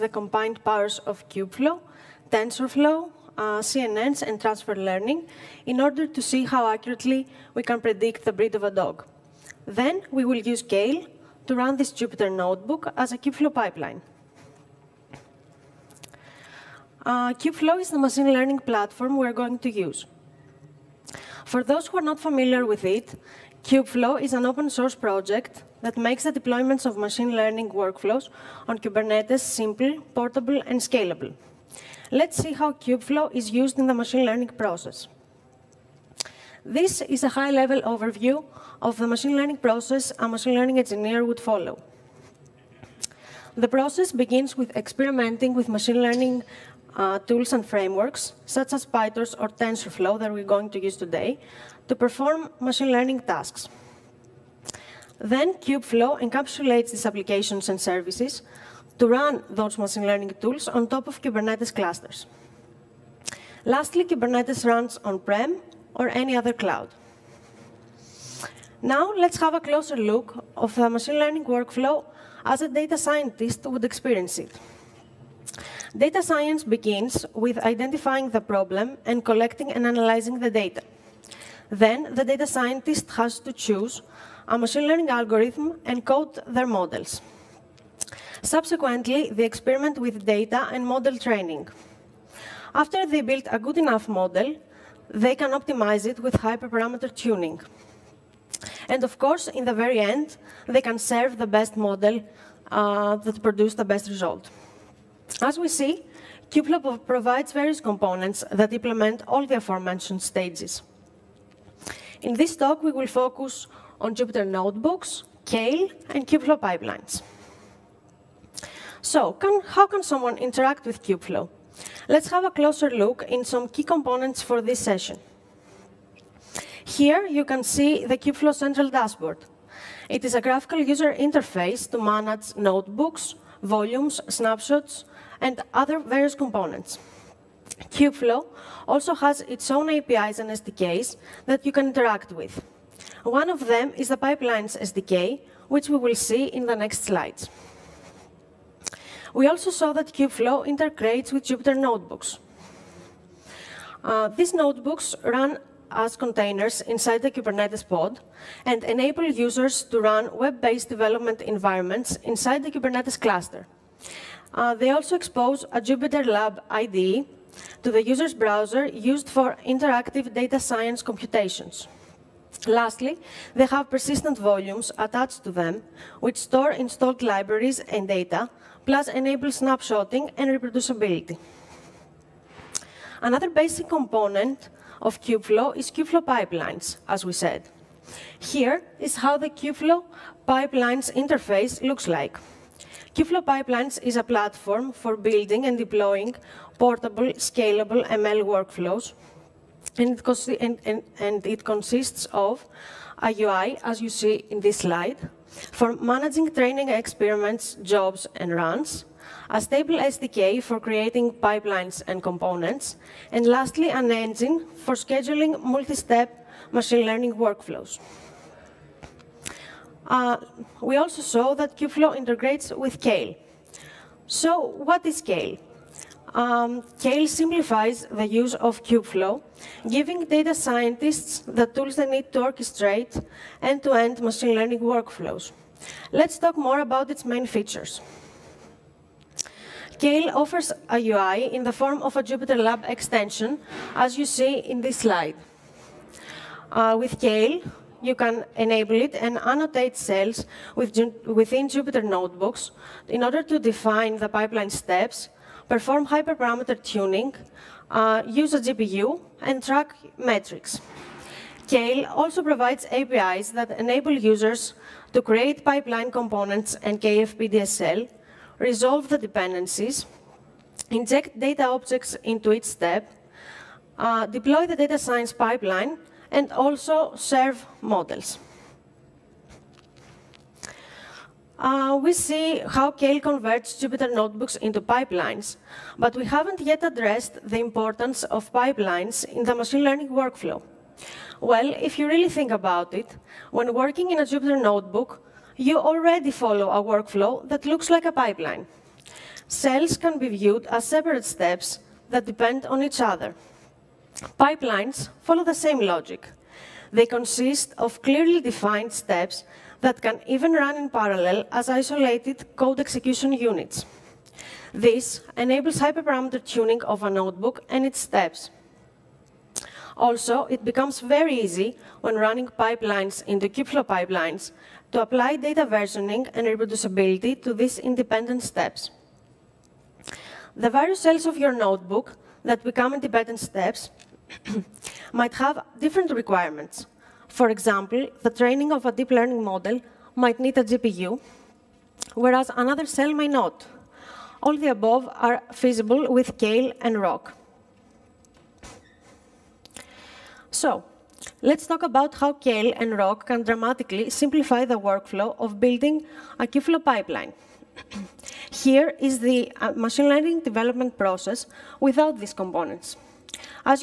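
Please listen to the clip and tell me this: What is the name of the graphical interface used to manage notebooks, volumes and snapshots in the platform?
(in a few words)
Kubeflow Central Dashboard.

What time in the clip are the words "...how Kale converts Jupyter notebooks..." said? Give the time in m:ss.
4:42.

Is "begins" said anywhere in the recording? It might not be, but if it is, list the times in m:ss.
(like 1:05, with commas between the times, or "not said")
0:44, 1:16.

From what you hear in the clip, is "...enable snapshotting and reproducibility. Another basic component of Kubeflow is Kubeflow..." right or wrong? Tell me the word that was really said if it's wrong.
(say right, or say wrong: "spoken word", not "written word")
right.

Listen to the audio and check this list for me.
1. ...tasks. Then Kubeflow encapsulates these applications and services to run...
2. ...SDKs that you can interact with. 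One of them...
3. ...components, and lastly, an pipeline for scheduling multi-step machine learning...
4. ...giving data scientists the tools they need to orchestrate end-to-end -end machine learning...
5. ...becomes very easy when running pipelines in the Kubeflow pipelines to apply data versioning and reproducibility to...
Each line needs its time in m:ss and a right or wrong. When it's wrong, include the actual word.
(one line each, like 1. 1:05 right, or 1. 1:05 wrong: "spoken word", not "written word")
1. 0:53 right
2. 2:20 right
3. 3:32 wrong: "engine", not "pipeline"
4. 3:49 right
5. 5:20 right.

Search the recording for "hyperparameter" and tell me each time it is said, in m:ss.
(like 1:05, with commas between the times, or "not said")
1:36, 4:16, 5:15.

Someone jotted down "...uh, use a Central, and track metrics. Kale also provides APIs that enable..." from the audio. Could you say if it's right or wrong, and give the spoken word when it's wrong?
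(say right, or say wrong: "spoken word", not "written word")
wrong: "GPU", not "Central".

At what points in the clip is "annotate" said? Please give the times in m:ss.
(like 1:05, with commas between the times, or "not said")
4:09.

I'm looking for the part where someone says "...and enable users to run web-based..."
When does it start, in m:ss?
2:38.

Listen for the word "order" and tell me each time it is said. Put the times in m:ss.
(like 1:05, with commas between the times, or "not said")
0:05, 4:13.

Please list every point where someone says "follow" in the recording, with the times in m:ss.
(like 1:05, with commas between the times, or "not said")
0:41, 4:56, 5:05.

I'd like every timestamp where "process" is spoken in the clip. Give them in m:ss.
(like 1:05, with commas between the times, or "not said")
0:34, 0:39, 0:43, 6:00.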